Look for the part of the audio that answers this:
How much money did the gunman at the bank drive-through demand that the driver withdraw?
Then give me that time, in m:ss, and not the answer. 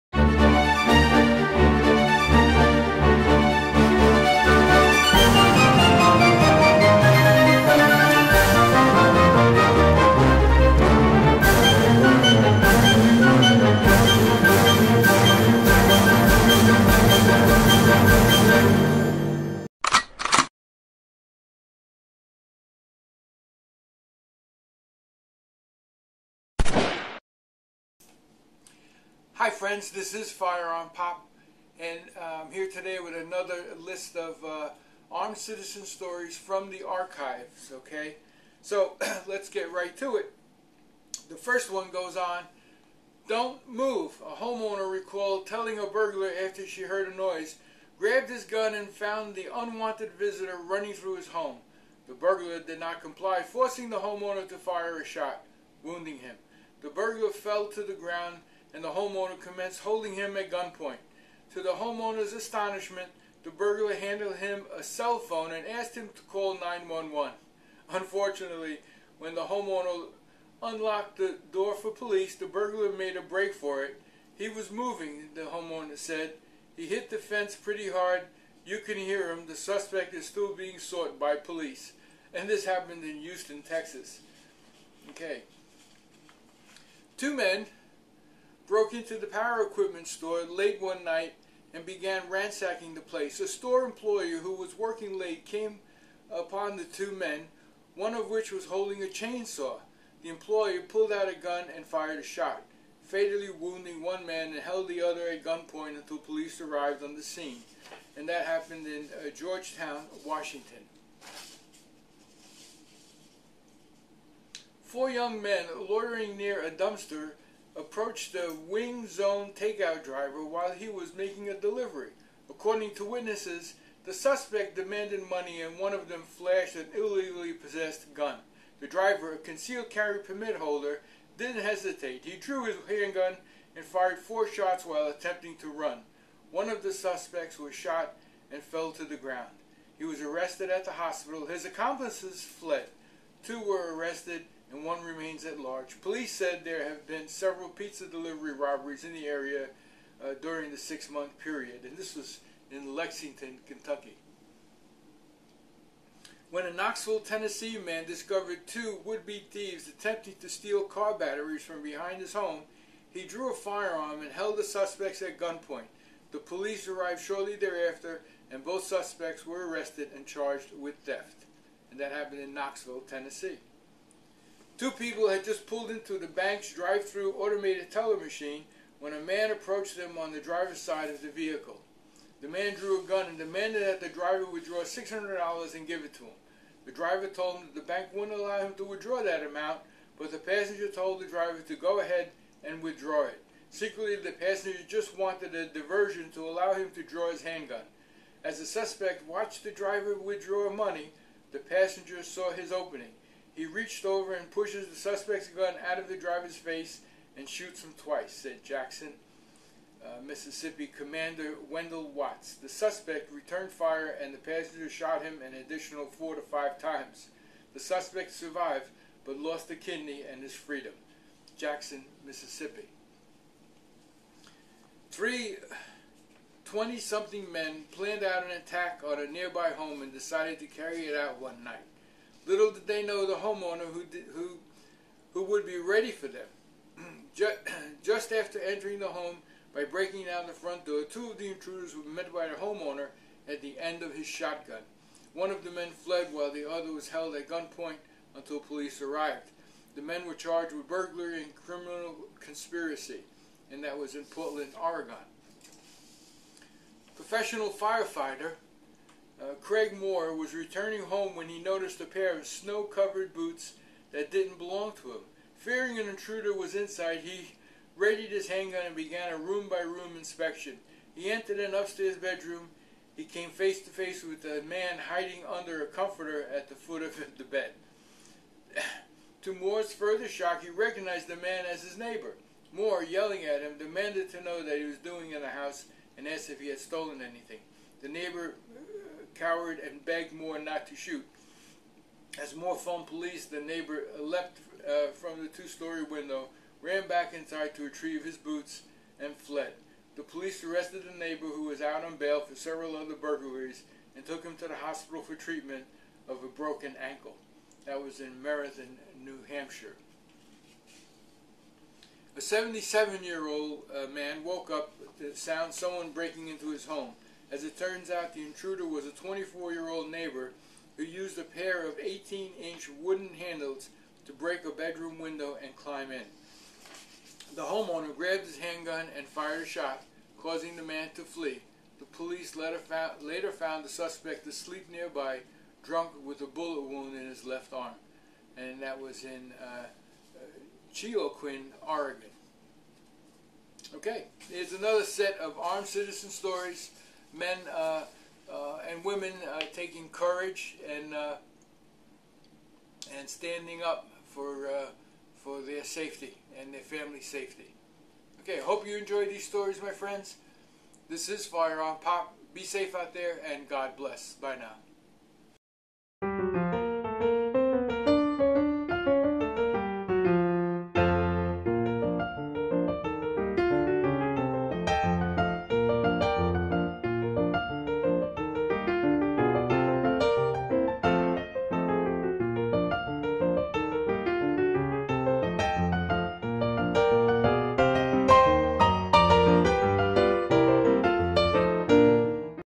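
3:04.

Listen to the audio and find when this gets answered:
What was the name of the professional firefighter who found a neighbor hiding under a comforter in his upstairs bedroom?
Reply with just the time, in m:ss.
4:19.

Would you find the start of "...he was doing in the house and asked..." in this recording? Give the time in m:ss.
4:44.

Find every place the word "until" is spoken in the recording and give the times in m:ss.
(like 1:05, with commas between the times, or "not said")
1:45, 4:08.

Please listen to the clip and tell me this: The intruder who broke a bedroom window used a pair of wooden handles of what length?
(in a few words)
18 inches.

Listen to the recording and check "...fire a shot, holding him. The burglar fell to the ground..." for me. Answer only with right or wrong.
wrong.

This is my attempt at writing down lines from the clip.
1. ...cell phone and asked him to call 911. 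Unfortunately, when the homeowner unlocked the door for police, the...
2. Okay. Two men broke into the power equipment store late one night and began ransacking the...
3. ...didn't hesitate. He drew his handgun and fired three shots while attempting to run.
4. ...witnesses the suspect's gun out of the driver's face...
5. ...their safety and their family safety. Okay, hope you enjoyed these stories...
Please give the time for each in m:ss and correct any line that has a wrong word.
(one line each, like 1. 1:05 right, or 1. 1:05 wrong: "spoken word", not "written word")
1. 1:04 right
2. 1:25 right
3. 2:11 wrong: "four", not "three"
4. 3:24 wrong: "pushes", not "witnesses"
5. 5:55 right.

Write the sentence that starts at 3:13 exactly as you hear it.
Secretly, the passenger just wanted a diversion to allow him to draw his handgun.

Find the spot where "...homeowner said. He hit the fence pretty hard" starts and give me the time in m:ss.
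1:15.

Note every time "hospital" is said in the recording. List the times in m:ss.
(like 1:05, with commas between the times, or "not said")
2:20, 5:04.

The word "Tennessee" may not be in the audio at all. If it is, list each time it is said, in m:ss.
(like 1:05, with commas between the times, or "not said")
2:37, 2:53.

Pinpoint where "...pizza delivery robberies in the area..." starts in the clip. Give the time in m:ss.
2:27.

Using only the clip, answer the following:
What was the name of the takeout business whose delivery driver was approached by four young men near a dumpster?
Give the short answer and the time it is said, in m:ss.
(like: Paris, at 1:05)
Wing Zone, at 1:58.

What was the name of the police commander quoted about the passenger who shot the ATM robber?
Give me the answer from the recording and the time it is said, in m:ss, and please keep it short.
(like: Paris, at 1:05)
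Wendell Watts, at 3:31.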